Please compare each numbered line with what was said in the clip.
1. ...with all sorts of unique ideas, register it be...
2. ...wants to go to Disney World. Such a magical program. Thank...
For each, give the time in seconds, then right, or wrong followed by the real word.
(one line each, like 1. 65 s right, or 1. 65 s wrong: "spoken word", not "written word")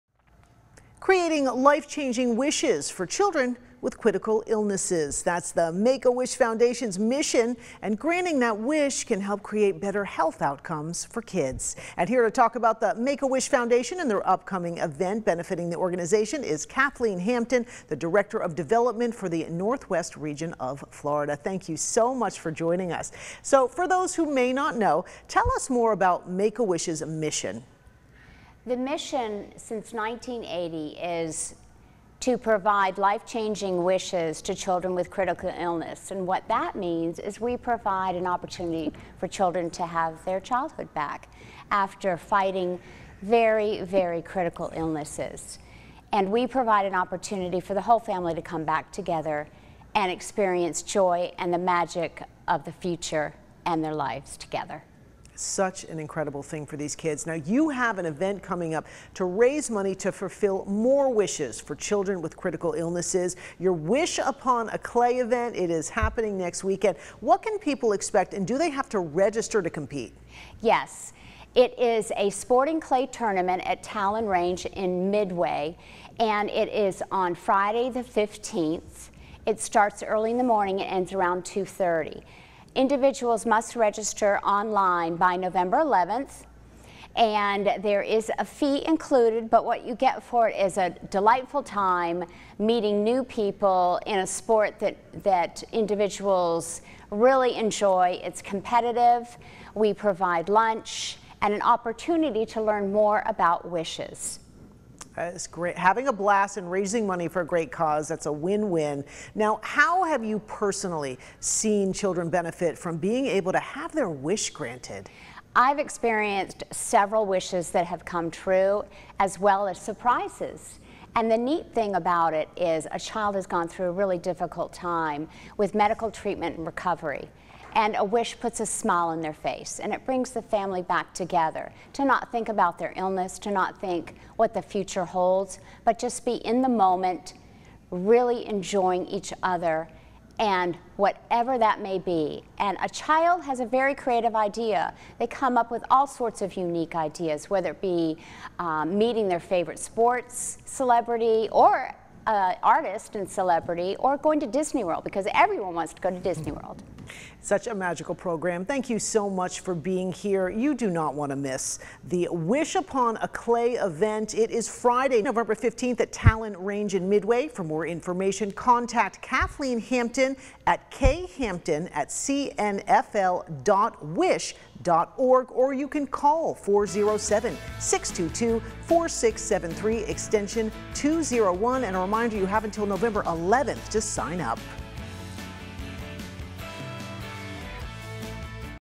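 1. 145 s wrong: "whether", not "register"
2. 155 s right.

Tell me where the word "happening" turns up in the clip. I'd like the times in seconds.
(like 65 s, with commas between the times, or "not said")
65 s.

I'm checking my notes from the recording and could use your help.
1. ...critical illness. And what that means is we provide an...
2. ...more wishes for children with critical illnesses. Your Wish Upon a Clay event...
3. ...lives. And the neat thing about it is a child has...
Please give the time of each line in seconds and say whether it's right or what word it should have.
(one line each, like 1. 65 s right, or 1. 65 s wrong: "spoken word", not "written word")
1. 35 s right
2. 60 s right
3. 119 s wrong: "surprises", not "lives".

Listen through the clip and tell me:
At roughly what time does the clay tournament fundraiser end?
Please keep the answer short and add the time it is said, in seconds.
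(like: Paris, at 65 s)
2:30, at 81 s.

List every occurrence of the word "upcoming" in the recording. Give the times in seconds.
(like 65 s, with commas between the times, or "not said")
14 s.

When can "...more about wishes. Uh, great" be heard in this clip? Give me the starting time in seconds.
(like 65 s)
102 s.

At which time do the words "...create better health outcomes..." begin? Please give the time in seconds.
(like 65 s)
9 s.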